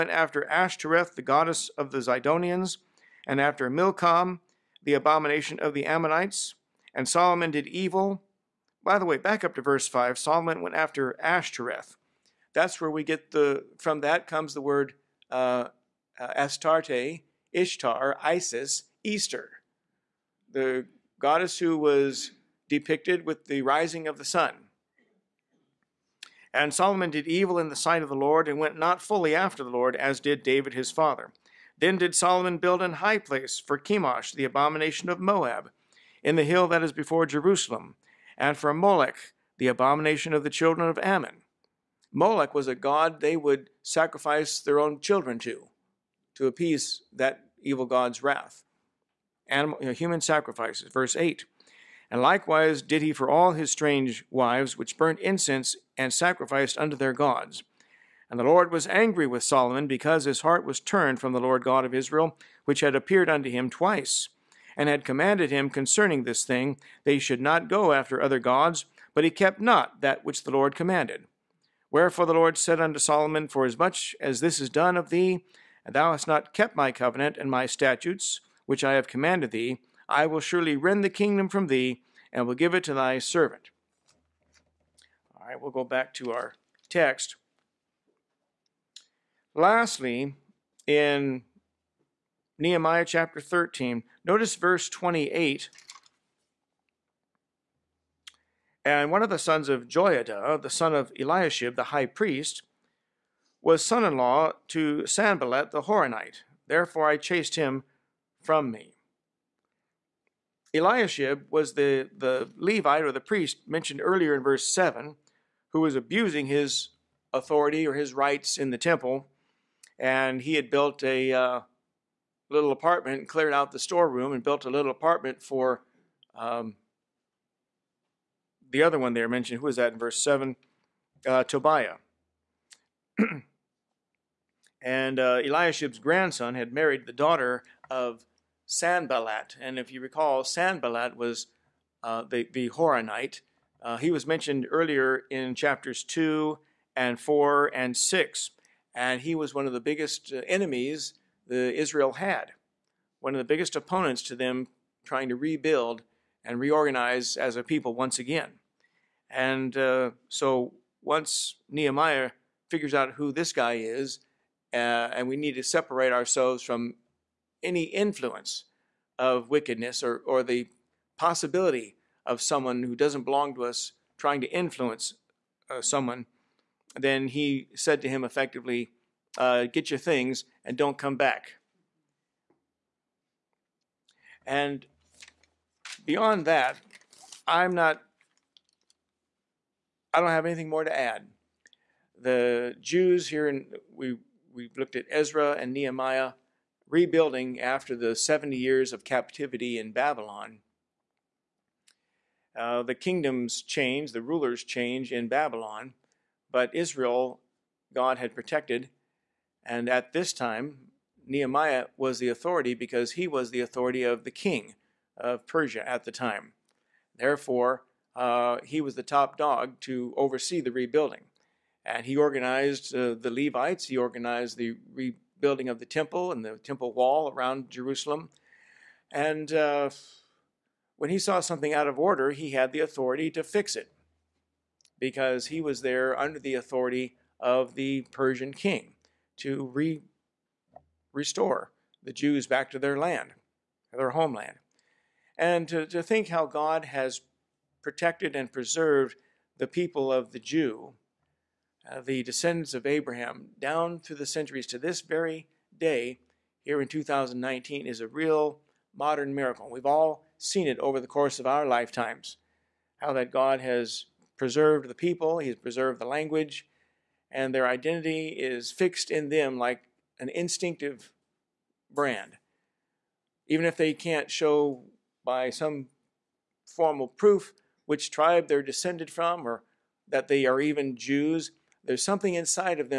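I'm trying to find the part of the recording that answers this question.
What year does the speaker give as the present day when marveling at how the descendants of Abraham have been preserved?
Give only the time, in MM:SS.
04:16.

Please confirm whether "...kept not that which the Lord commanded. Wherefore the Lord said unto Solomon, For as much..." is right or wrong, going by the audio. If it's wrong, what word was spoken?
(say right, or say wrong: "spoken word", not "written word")
right.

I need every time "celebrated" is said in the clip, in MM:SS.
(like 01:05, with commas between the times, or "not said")
not said.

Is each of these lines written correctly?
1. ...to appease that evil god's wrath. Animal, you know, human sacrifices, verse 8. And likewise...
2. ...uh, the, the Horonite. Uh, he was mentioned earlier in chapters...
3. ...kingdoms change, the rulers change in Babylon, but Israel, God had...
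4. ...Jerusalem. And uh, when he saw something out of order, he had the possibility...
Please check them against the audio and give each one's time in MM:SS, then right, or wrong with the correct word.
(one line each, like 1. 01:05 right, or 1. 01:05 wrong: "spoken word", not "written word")
1. 00:46 right
2. 02:22 right
3. 03:22 right
4. 03:47 wrong: "authority", not "possibility".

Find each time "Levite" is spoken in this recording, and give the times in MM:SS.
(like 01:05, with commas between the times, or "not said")
01:52, 03:43.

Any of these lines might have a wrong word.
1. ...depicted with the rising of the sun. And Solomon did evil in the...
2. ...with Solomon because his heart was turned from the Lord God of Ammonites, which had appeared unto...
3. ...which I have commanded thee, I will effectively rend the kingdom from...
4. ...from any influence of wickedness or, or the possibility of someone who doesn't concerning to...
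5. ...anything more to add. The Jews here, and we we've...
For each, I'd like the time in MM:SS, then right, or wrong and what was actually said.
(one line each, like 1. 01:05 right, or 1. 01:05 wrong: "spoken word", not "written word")
1. 00:22 right
2. 00:59 wrong: "Israel", not "Ammonites"
3. 01:18 wrong: "surely", not "effectively"
4. 02:46 wrong: "belong", not "concerning"
5. 03:10 right.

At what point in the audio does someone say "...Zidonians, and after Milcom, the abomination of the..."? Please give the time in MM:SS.
00:02.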